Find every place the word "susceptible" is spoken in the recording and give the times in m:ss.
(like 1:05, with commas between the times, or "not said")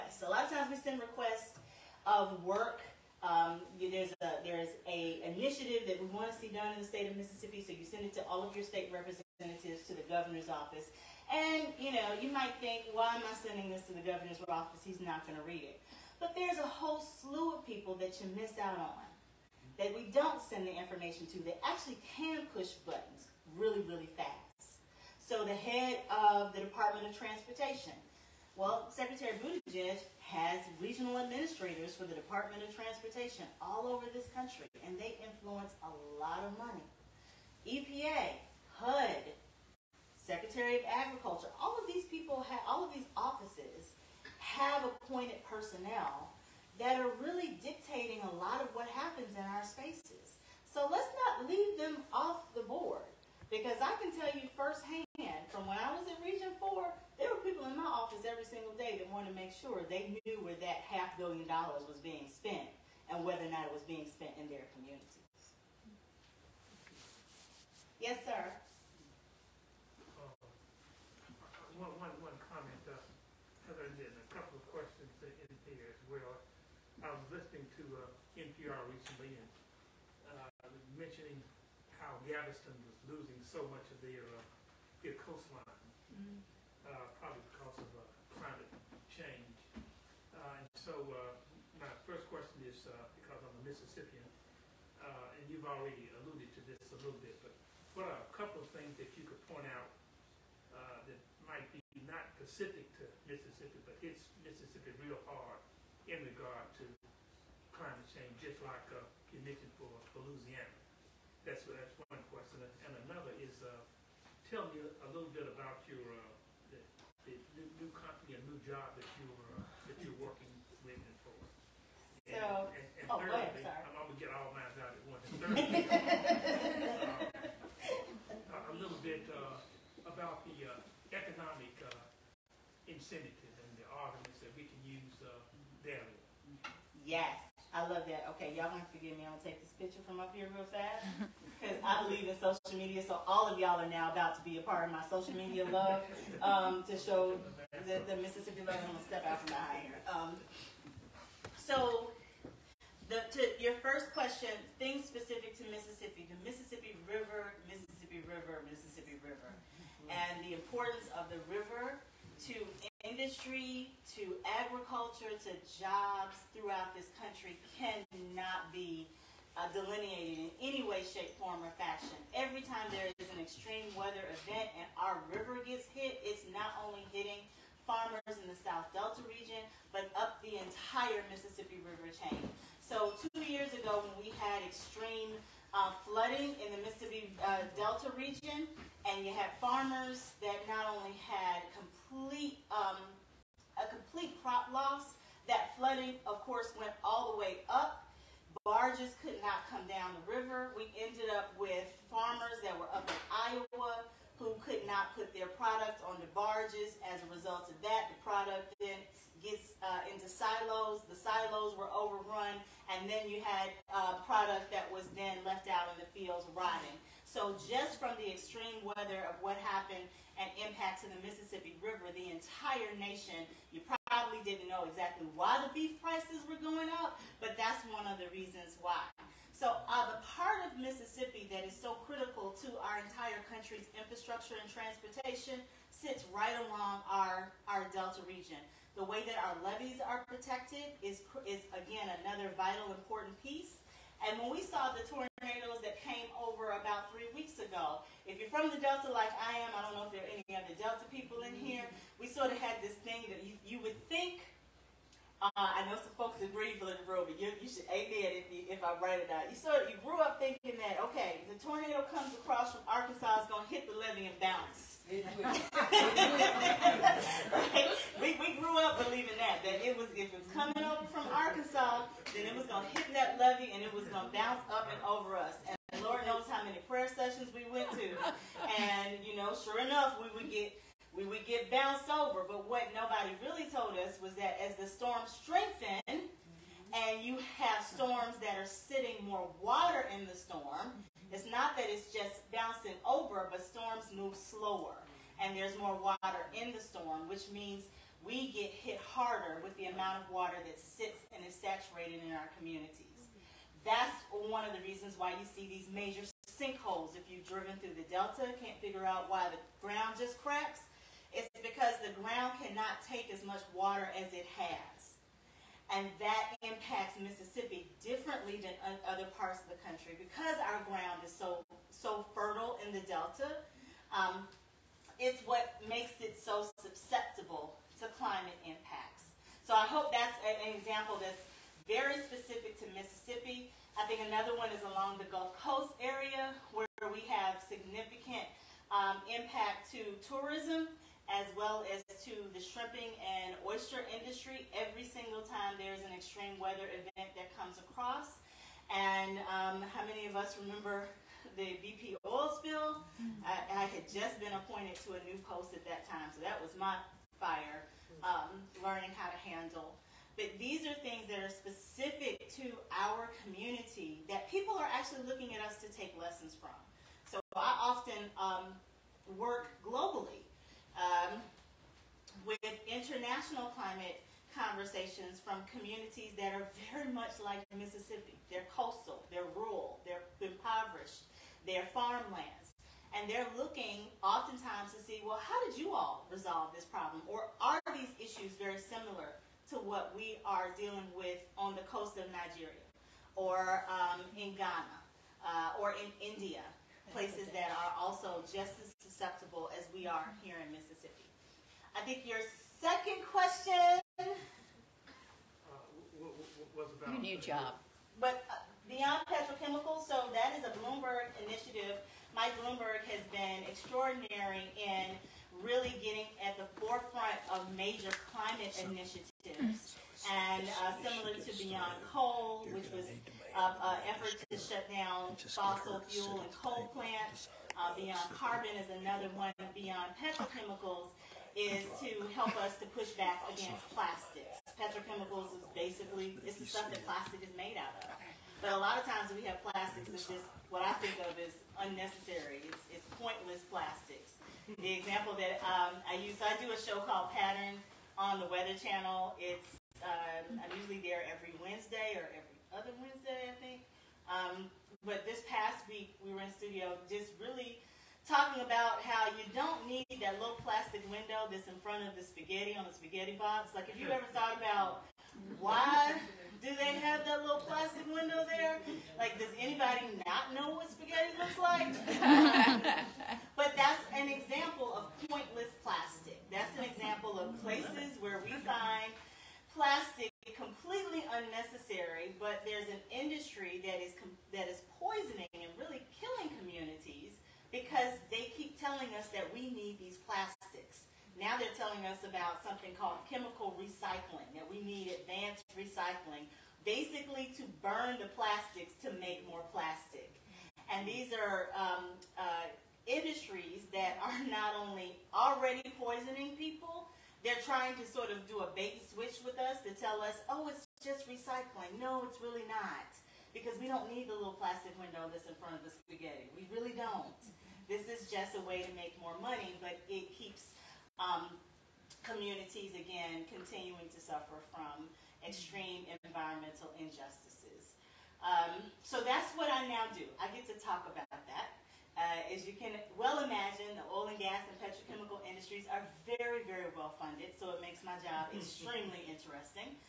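5:26, 6:38.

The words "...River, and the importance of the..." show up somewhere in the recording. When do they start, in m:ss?
2:39.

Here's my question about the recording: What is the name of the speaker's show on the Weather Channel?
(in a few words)
Pattern.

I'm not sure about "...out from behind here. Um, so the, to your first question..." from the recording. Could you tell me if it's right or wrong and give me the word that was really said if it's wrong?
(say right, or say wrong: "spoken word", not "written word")
right.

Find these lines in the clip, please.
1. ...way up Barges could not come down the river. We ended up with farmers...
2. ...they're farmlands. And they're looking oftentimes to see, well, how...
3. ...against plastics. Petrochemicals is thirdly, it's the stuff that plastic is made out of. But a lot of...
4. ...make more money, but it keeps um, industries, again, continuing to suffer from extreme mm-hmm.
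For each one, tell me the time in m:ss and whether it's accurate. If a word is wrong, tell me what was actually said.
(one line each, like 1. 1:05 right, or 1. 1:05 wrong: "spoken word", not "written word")
1. 3:17 right
2. 6:21 right
3. 7:13 wrong: "basically", not "thirdly"
4. 8:38 wrong: "communities", not "industries".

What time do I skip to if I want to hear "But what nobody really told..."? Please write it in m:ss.
4:42.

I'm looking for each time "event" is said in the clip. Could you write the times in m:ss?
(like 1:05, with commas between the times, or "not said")
2:54, 5:46.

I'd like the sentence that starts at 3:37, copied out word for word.
So just from the extreme weather of what happened and impact to the Mississippi River, the entire nation.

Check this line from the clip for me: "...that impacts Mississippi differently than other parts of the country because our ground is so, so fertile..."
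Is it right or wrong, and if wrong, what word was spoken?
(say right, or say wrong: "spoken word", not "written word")
right.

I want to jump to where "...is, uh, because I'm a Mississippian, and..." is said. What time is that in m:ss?
1:32.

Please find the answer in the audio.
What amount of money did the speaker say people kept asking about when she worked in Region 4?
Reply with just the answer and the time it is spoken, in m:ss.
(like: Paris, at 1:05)
half billion dollars, at 1:00.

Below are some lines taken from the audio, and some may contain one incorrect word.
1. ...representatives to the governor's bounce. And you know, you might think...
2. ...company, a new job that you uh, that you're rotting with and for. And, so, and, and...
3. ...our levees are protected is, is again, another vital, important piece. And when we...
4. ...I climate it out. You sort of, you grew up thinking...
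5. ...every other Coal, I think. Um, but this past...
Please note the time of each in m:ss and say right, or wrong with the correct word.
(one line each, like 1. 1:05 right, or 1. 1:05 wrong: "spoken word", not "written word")
1. 0:08 wrong: "office", not "bounce"
2. 1:57 wrong: "working", not "rotting"
3. 3:59 right
4. 4:18 wrong: "write", not "climate"
5. 7:32 wrong: "Wednesday", not "Coal".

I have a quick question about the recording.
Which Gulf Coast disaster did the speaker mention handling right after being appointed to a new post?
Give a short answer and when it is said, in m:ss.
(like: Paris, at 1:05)
BP oil spill, at 5:51.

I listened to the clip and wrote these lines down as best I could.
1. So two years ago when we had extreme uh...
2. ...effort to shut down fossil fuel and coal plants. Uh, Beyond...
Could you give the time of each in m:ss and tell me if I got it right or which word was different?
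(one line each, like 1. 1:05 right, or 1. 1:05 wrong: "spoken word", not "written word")
1. 3:02 right
2. 7:04 right.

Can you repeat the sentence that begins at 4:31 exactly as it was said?
Arkansas, then it was going to hit that levee and it was going to bounce up and over us.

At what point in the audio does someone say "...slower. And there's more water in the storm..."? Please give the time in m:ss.
4:54.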